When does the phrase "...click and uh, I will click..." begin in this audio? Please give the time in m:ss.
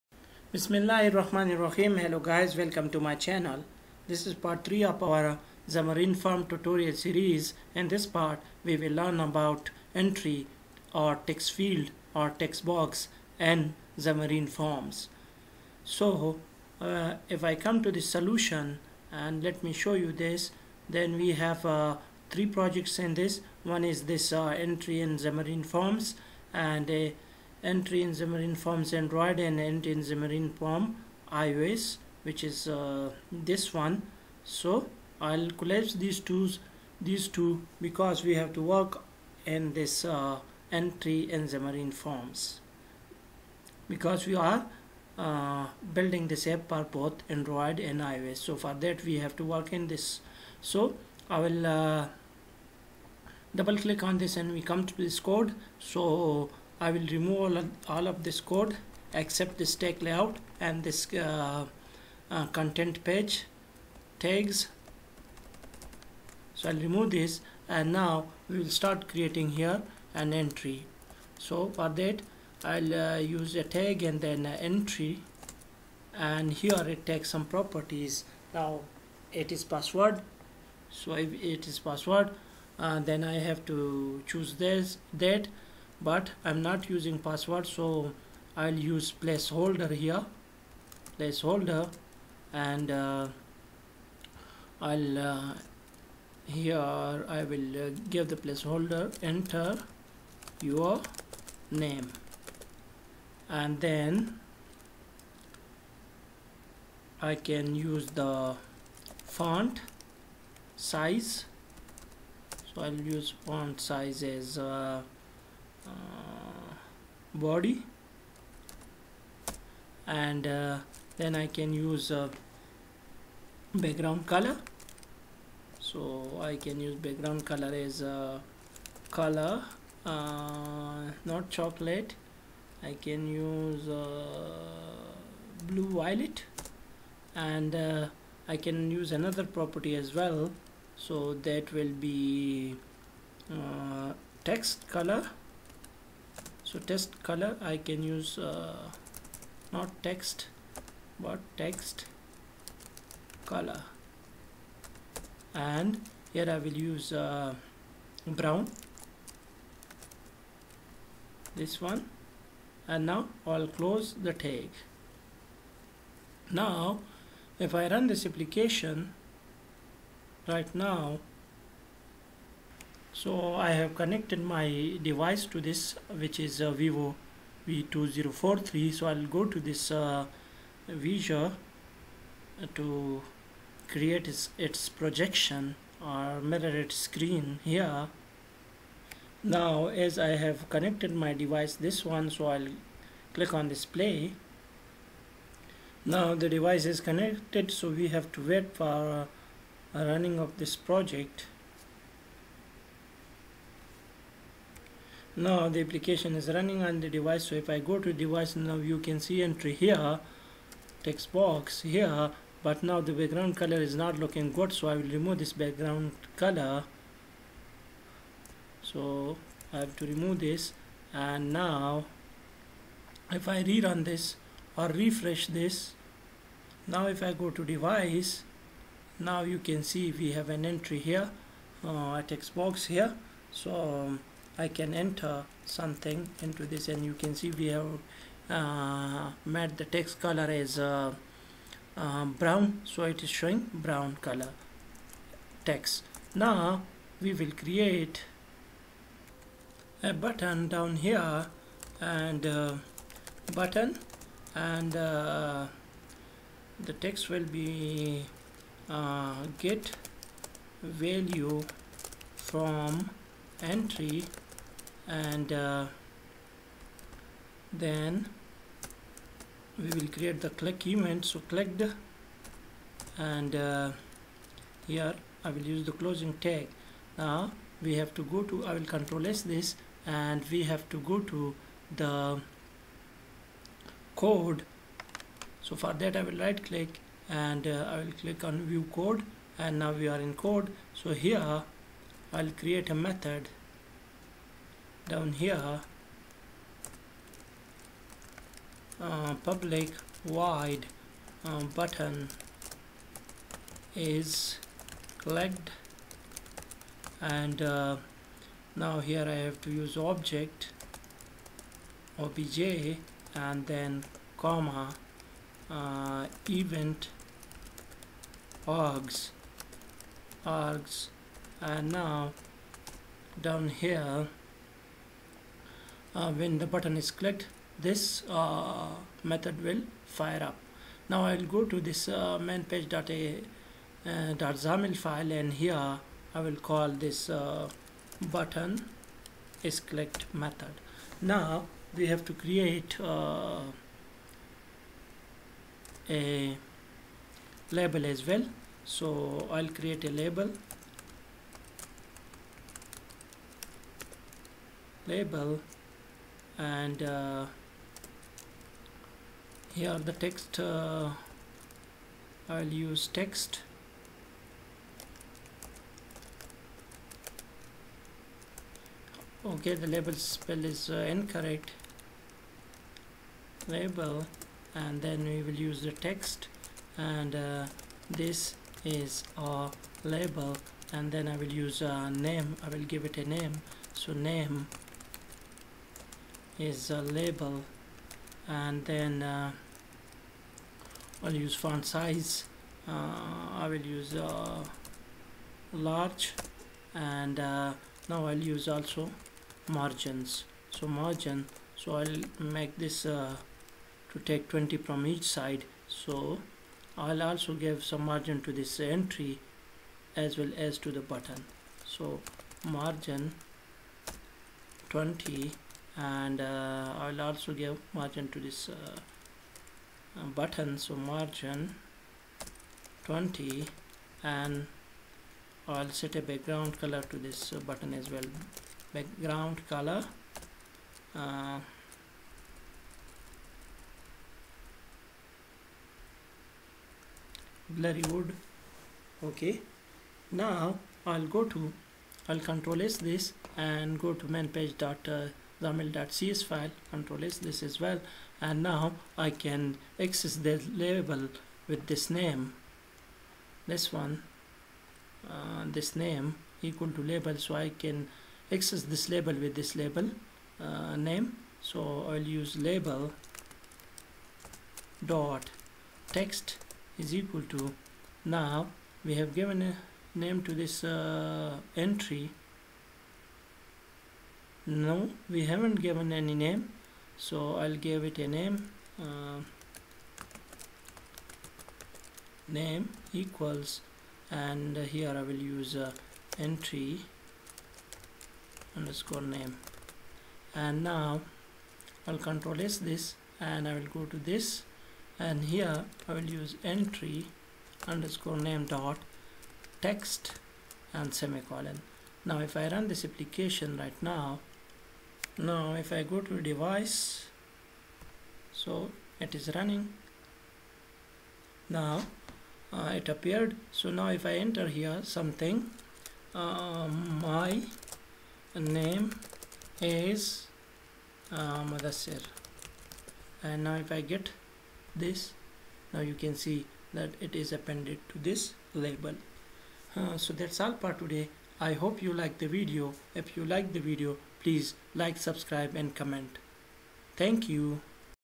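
4:46.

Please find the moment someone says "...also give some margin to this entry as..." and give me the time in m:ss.
6:47.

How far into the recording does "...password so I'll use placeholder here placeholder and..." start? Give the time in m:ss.
1:27.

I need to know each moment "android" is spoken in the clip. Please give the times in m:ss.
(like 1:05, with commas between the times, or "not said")
0:28, 0:47.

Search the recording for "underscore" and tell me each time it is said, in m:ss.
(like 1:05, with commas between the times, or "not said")
8:08, 8:17.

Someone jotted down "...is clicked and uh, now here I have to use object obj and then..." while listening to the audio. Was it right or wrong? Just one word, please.
right.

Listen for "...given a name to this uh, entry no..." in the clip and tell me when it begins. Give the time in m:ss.
7:49.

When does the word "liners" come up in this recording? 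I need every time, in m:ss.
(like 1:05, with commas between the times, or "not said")
not said.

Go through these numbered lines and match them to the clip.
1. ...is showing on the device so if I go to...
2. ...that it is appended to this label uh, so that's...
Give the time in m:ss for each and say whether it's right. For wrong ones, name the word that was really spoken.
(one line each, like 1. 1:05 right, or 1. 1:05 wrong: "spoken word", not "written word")
1. 3:26 wrong: "running", not "showing"
2. 8:46 right.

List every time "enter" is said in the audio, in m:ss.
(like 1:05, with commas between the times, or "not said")
1:39, 3:54, 8:34.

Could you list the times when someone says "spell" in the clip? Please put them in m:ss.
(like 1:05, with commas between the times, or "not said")
6:10.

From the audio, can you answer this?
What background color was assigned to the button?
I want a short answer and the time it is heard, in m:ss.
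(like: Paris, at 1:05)
Burly wood, at 7:17.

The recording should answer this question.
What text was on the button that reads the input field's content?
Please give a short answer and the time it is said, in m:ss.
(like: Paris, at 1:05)
Get value from entry, at 4:19.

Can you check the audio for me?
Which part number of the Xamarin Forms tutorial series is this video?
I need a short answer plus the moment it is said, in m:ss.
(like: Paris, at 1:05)
3, at 0:04.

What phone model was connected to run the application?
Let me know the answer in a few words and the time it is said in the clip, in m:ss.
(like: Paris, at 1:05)
Vivo V2043, at 2:56.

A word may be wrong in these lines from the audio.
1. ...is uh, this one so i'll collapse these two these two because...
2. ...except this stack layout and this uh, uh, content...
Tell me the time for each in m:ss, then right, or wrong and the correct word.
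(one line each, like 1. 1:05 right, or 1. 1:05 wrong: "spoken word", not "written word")
1. 0:32 right
2. 0:59 right.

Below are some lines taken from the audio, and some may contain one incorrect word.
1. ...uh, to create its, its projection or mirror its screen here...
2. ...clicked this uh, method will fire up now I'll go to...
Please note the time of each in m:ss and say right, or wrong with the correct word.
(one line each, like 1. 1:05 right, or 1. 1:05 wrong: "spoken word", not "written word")
1. 3:00 right
2. 5:27 right.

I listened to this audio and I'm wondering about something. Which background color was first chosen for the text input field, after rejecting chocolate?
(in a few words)
Blue violet.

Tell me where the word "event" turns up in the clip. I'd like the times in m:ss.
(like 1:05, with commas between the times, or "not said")
4:30, 5:16.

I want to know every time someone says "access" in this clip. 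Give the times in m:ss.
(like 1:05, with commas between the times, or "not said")
7:29, 7:38.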